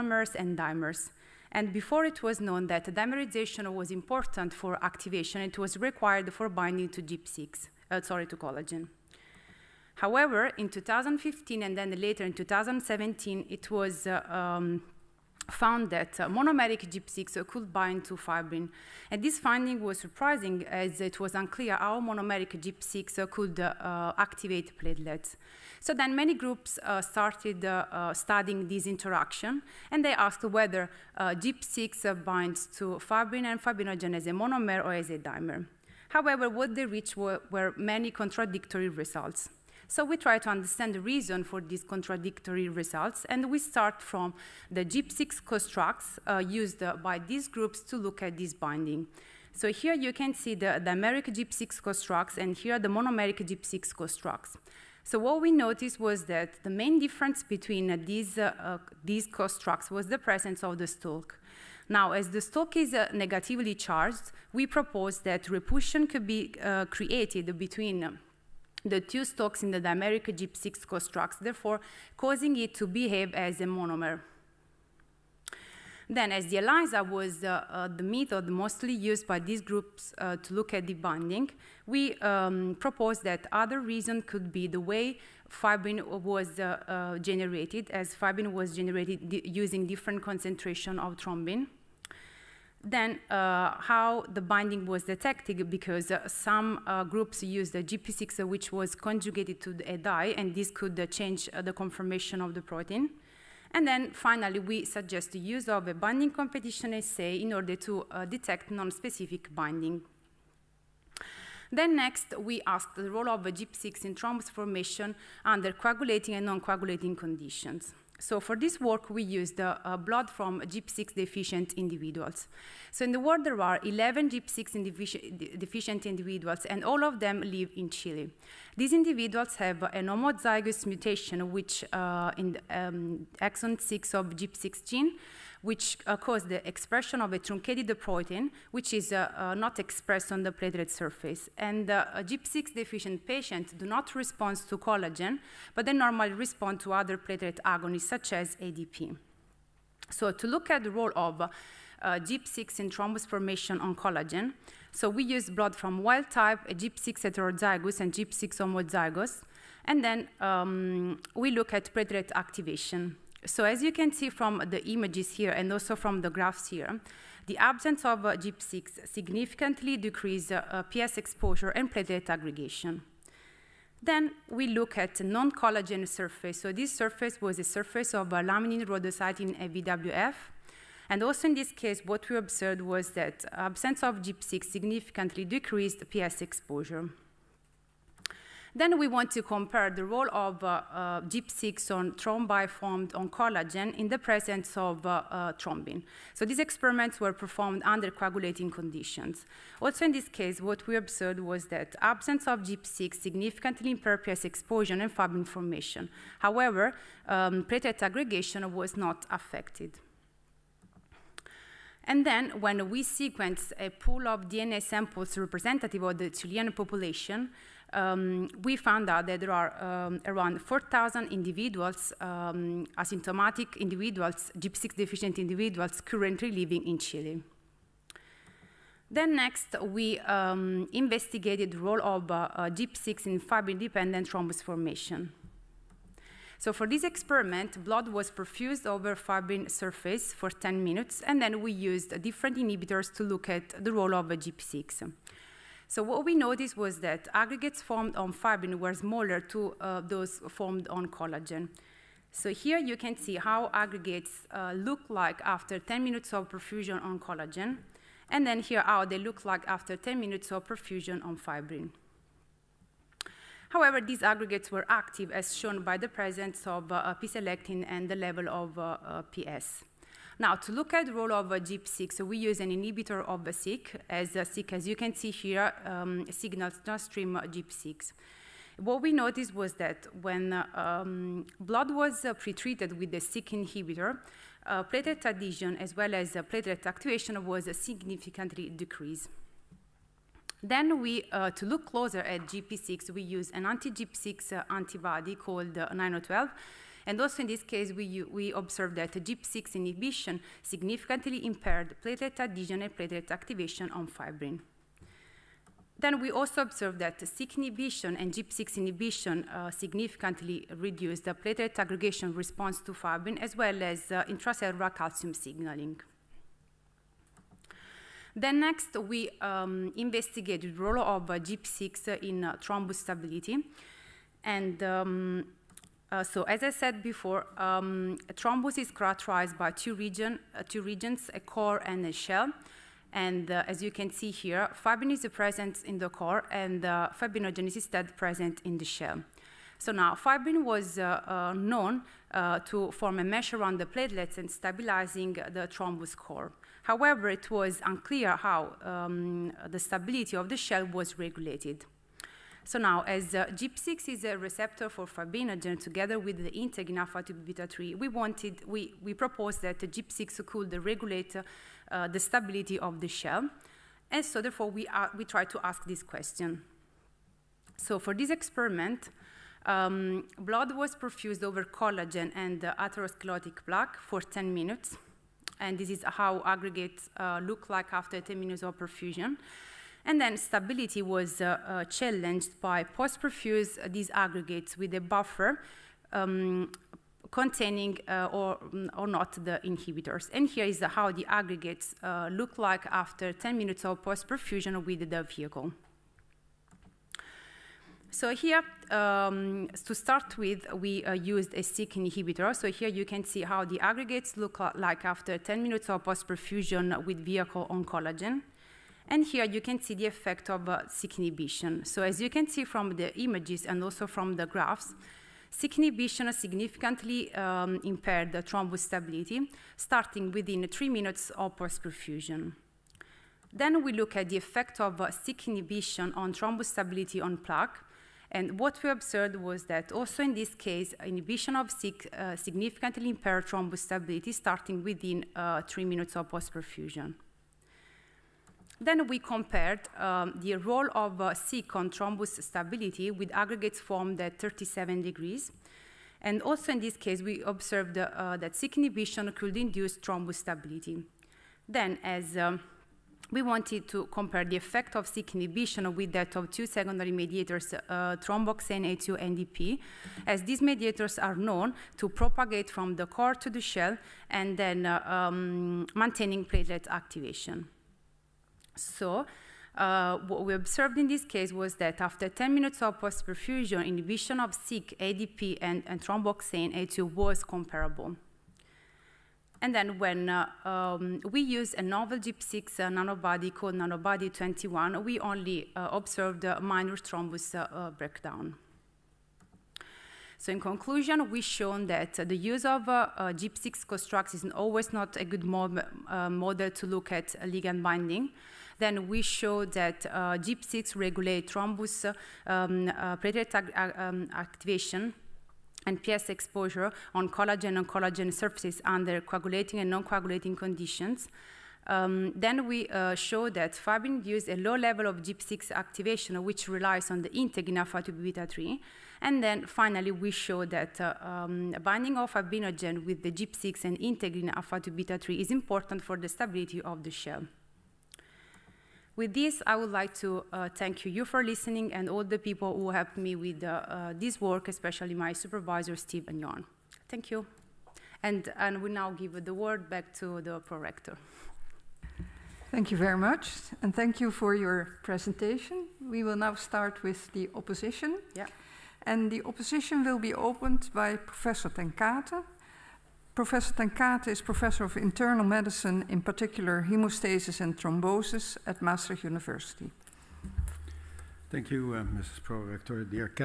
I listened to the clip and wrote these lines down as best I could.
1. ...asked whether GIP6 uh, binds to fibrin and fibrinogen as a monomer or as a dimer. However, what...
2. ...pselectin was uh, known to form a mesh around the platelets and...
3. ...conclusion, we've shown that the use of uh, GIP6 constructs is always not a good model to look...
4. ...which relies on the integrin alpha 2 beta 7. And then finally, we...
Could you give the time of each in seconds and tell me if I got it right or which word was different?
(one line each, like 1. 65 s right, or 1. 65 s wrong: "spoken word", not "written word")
1. 30 s right
2. 340 s wrong: "fibrin", not "pselectin"
3. 490 s right
4. 516 s wrong: "3", not "7".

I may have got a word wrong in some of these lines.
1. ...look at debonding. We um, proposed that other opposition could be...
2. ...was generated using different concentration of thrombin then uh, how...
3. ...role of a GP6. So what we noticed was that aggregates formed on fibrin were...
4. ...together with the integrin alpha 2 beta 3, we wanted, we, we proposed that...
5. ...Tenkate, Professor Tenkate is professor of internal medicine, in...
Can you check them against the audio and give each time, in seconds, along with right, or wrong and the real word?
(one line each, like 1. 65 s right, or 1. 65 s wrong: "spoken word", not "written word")
1. 80 s wrong: "reason", not "opposition"
2. 88 s right
3. 243 s right
4. 355 s right
5. 551 s right.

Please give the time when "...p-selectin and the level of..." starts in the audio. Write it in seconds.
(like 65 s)
267 s.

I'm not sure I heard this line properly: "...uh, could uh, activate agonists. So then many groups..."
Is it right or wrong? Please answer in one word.
wrong.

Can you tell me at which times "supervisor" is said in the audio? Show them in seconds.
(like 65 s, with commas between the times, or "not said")
535 s.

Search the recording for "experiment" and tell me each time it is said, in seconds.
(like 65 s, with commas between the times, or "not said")
196 s, 237 s, 368 s.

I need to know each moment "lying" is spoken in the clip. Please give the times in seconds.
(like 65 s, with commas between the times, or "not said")
not said.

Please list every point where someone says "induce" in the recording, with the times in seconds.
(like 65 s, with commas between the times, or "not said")
449 s, 514 s.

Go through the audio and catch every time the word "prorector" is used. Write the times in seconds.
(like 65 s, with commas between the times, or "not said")
540 s, 562 s.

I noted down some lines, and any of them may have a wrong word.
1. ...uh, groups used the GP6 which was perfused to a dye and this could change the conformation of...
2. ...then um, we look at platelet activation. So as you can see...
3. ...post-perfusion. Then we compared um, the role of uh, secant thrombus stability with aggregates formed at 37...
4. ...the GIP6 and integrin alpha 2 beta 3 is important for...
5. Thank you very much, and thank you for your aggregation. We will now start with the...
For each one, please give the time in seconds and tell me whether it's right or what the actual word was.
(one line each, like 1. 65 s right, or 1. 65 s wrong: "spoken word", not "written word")
1. 96 s wrong: "conjugated", not "perfused"
2. 160 s right
3. 436 s right
4. 523 s right
5. 542 s wrong: "presentation", not "aggregation".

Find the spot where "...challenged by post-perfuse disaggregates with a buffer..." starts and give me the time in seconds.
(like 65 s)
381 s.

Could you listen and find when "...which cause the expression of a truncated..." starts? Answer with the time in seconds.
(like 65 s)
135 s.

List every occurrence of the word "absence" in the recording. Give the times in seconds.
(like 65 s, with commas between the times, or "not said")
167 s, 183 s, 201 s.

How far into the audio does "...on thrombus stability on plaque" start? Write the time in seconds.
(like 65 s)
426 s.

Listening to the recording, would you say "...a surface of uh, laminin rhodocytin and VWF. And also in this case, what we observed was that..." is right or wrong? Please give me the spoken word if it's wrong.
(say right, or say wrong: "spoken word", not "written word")
right.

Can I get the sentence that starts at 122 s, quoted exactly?
So in the world, there are 11 GIP6 deficient individuals, and all of them live in Chile.